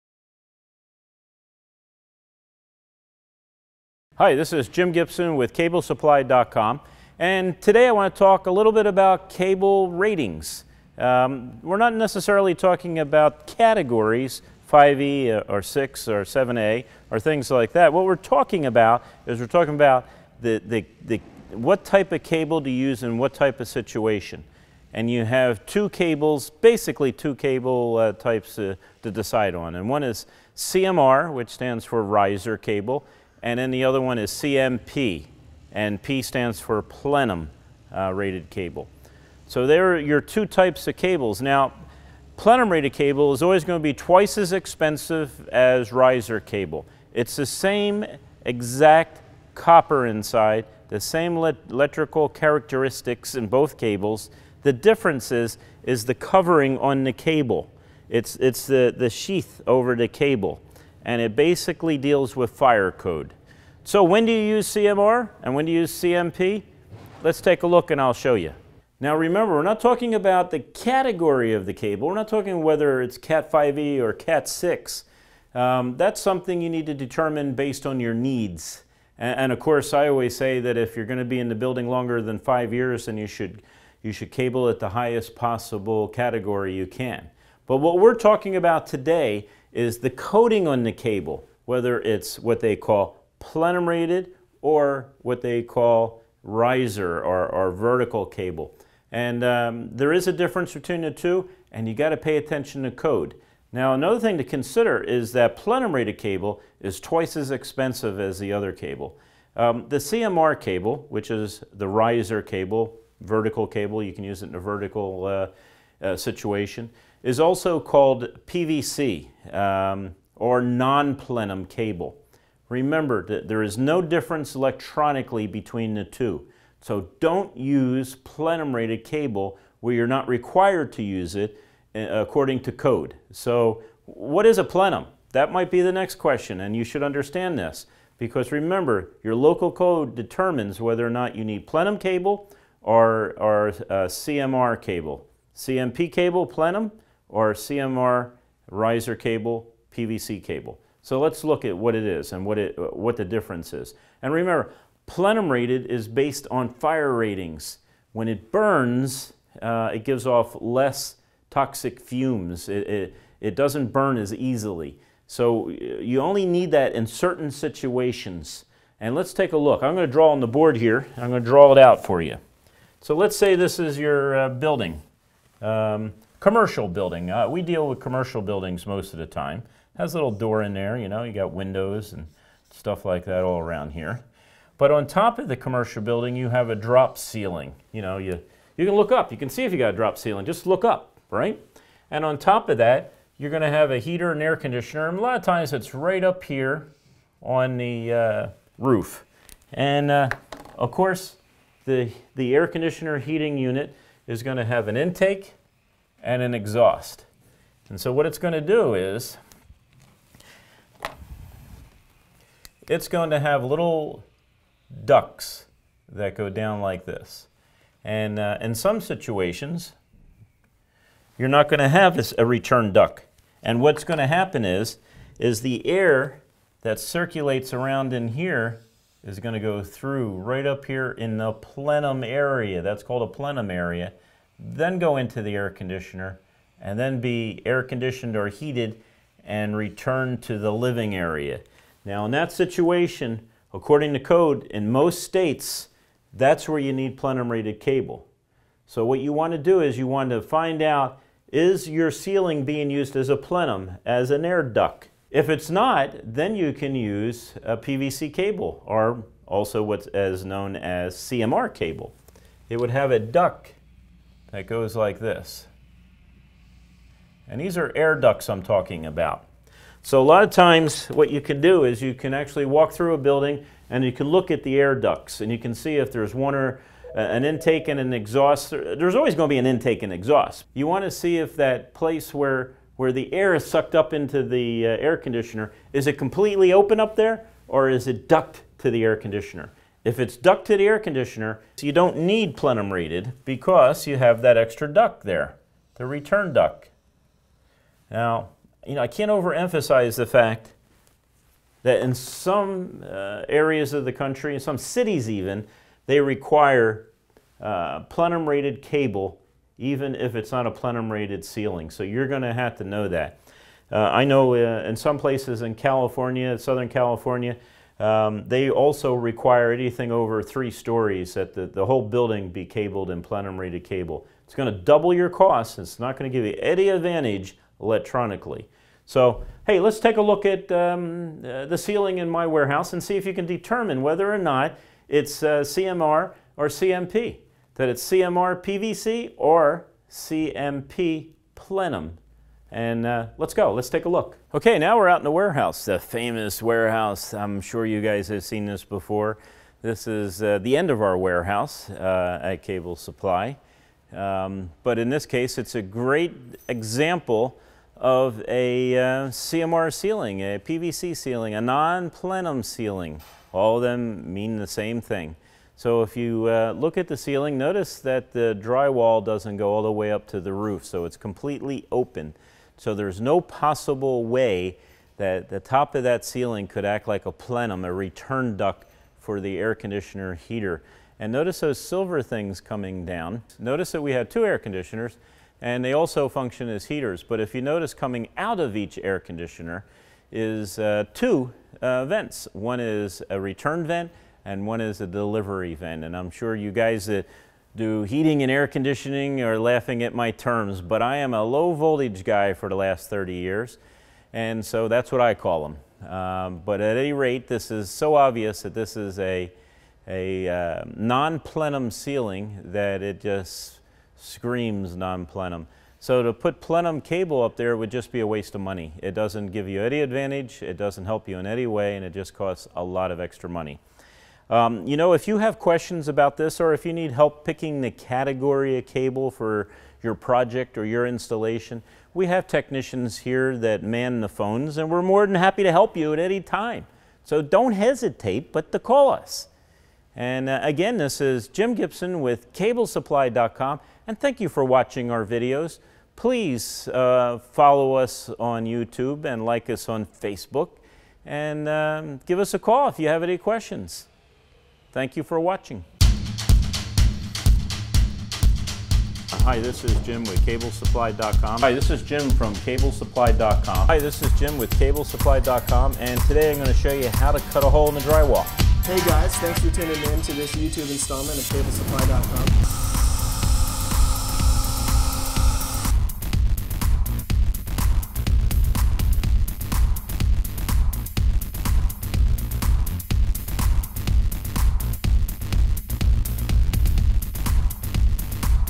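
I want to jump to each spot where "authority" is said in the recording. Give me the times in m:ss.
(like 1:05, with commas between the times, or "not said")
not said.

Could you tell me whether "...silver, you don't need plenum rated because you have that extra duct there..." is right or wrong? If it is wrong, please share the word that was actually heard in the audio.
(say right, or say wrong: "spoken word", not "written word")
wrong: "conditioner", not "silver".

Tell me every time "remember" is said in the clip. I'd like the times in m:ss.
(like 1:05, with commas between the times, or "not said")
1:09, 2:02, 2:18, 2:34.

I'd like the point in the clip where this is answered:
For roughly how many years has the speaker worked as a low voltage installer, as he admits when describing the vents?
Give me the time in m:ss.
6:43.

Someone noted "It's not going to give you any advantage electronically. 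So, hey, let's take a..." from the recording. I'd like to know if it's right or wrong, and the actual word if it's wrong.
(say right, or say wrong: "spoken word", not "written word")
right.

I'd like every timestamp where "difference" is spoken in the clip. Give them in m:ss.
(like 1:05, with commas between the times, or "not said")
0:54, 1:40, 2:04, 2:33.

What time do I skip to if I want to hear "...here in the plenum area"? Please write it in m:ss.
3:50.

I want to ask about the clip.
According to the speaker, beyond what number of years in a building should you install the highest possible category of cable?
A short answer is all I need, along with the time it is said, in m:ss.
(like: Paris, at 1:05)
5, at 1:22.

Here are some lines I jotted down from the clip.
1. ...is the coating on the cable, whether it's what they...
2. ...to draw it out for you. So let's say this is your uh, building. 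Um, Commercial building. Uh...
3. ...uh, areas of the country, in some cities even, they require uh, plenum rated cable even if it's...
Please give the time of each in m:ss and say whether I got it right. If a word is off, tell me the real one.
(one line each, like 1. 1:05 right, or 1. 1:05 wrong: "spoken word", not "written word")
1. 1:29 right
2. 2:51 right
3. 5:03 right.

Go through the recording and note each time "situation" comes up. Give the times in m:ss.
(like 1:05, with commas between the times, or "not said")
0:23, 1:56, 2:47, 3:39, 4:02.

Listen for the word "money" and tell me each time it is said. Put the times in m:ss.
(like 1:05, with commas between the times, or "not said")
6:58, 7:03.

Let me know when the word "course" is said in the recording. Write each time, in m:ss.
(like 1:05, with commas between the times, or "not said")
1:19, 3:20.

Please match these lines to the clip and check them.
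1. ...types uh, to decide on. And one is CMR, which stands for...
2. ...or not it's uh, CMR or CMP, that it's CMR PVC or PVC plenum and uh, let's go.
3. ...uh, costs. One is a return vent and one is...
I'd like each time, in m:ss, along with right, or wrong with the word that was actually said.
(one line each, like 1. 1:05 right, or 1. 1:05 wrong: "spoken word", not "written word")
1. 0:28 right
2. 5:34 wrong: "CMP", not "PVC"
3. 6:31 wrong: "vents", not "costs".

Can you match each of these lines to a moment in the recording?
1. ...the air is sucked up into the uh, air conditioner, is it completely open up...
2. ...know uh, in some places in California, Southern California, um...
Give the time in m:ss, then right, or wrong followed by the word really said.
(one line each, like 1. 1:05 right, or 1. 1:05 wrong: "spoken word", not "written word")
1. 4:43 right
2. 5:14 right.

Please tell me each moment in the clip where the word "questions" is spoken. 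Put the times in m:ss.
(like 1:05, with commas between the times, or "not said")
2:16, 7:05, 7:33.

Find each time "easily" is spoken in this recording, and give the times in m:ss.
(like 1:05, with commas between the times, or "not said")
2:44.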